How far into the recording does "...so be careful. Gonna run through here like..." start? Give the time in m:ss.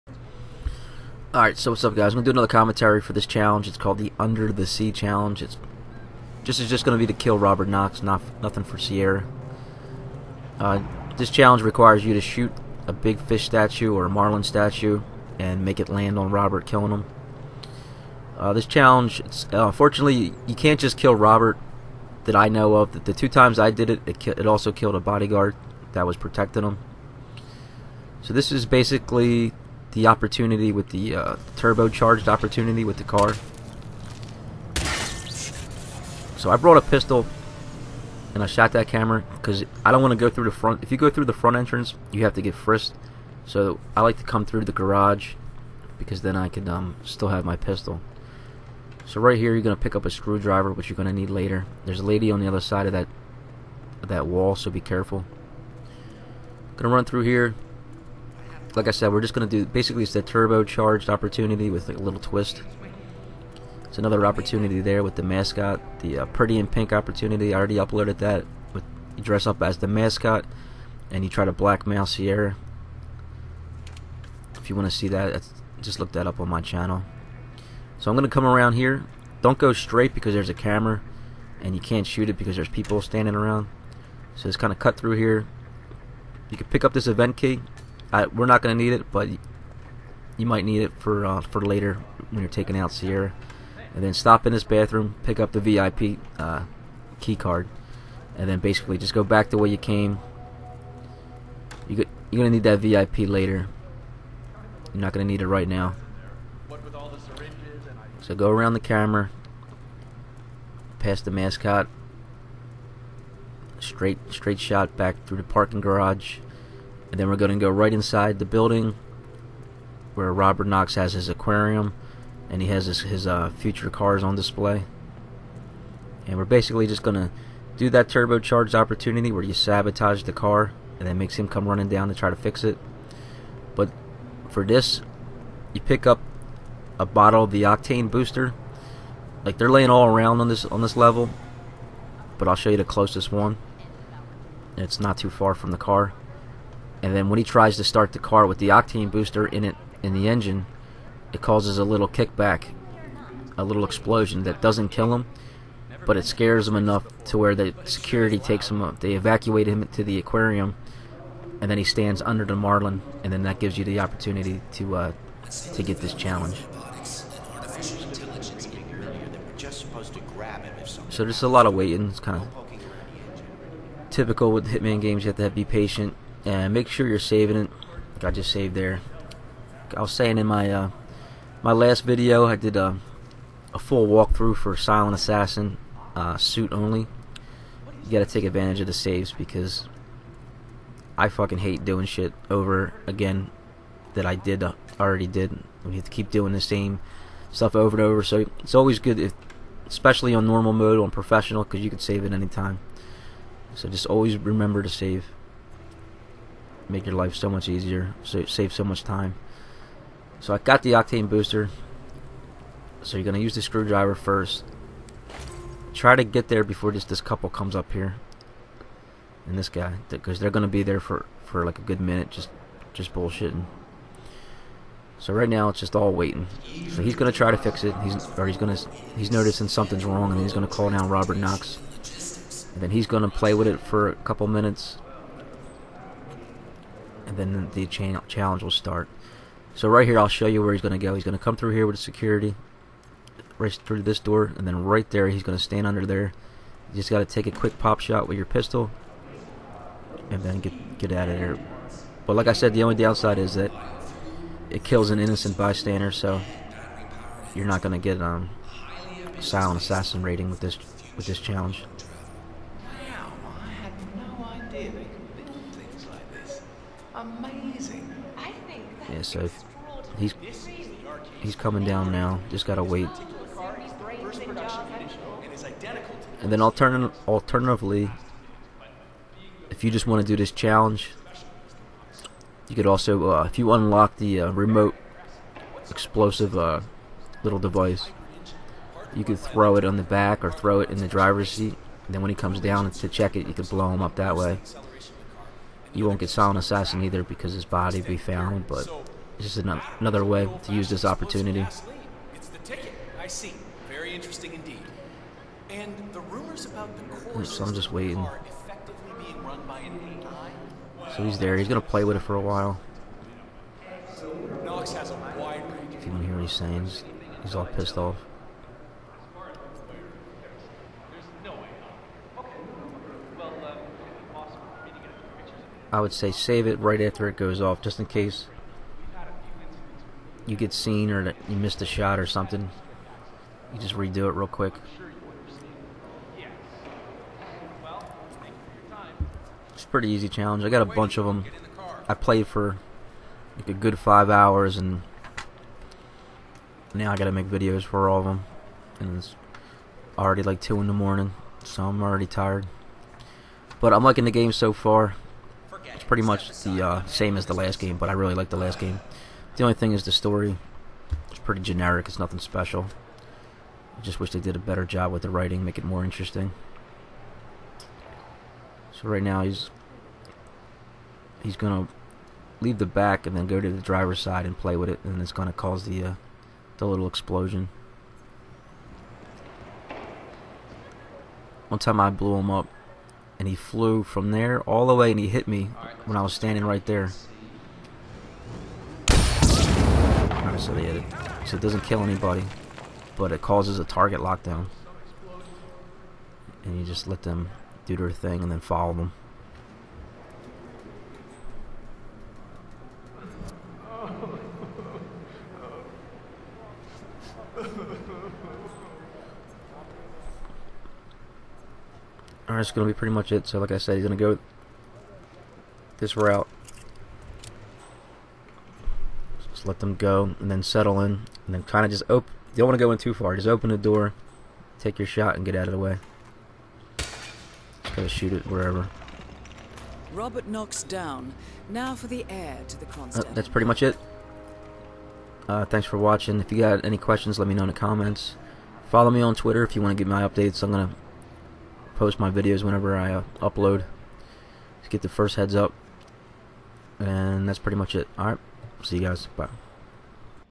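0:54.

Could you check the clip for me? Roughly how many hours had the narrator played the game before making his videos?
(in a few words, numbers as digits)
5 hours.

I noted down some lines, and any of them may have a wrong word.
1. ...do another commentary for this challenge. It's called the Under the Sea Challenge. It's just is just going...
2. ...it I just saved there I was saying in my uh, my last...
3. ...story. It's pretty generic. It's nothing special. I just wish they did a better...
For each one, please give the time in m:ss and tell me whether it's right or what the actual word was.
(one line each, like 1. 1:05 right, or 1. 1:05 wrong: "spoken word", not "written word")
1. 0:02 right
2. 2:57 right
3. 6:00 right.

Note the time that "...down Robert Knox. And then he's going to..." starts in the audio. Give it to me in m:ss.
3:50.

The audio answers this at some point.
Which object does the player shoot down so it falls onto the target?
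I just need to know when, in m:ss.
0:14.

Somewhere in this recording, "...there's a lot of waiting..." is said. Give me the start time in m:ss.
2:51.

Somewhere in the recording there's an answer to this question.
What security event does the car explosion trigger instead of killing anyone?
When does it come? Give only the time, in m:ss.
6:33.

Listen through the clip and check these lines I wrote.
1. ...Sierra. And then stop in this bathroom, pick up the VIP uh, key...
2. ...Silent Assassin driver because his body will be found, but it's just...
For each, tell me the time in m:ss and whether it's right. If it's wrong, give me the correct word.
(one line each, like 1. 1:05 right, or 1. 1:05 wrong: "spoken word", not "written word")
1. 1:32 right
2. 4:56 wrong: "either", not "driver".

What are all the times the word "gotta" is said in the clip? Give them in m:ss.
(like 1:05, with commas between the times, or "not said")
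3:08, 4:32, 7:07.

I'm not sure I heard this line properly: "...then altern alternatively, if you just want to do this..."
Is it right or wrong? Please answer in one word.
right.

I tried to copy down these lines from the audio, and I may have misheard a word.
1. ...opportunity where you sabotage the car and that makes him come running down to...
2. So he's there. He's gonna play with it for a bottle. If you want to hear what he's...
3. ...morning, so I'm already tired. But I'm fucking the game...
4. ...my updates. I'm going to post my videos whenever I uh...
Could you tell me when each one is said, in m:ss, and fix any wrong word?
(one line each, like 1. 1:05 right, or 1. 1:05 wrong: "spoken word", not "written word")
1. 2:08 right
2. 5:11 wrong: "while", not "bottle"
3. 5:50 wrong: "liking", not "fucking"
4. 7:20 right.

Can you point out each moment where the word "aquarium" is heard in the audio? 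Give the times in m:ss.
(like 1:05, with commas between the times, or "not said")
2:01, 2:40.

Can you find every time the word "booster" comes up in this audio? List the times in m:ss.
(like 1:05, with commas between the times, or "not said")
2:18, 2:29, 3:31.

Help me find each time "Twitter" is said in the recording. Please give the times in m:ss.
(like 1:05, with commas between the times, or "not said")
7:19.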